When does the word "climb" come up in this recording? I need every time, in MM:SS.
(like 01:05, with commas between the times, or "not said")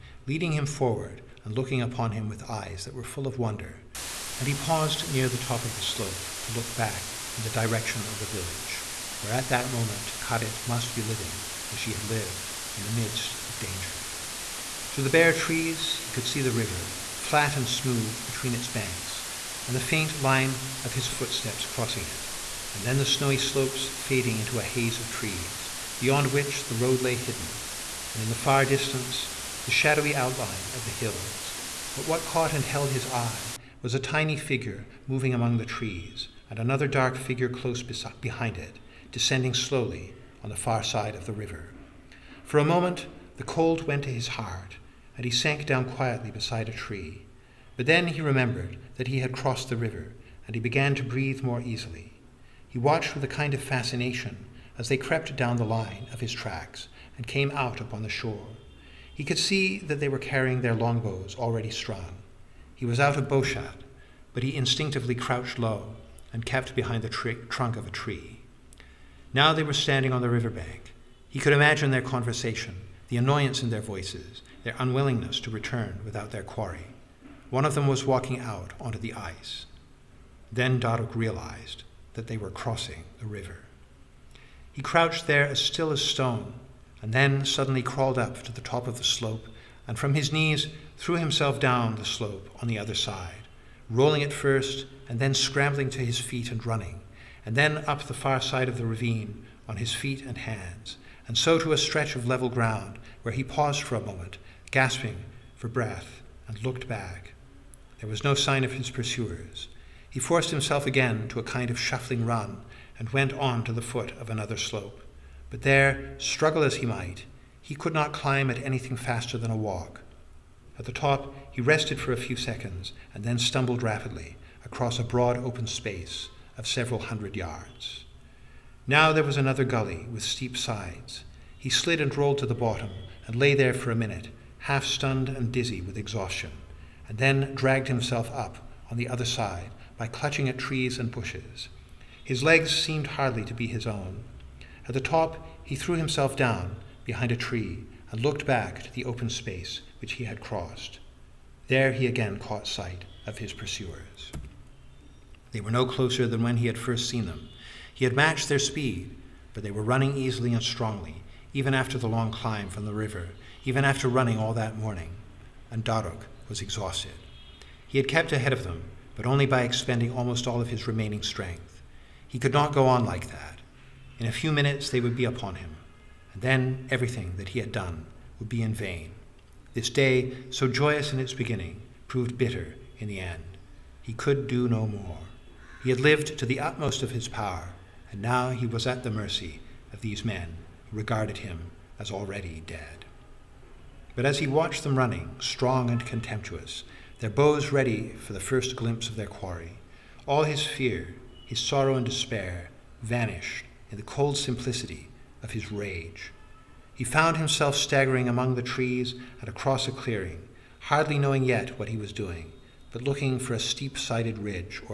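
01:58, 02:42.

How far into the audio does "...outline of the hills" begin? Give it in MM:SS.
00:30.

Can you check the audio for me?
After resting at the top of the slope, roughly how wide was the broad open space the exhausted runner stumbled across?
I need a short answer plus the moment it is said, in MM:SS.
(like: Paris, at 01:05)
Several hundred yards, at 02:06.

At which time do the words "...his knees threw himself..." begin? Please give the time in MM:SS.
01:30.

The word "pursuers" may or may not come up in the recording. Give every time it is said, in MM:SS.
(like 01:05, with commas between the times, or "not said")
01:48, 02:33.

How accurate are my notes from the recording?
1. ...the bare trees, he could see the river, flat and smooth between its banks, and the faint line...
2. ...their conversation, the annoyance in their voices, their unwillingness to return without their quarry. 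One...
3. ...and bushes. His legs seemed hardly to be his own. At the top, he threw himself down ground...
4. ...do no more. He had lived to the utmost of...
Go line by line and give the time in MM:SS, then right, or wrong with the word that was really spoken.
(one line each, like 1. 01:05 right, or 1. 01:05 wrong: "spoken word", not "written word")
1. 00:15 right
2. 01:11 right
3. 02:20 wrong: "behind", not "ground"
4. 03:04 right.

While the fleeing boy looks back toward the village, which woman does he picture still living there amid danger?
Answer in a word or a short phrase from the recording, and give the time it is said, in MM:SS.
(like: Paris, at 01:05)
Karet, at 00:10.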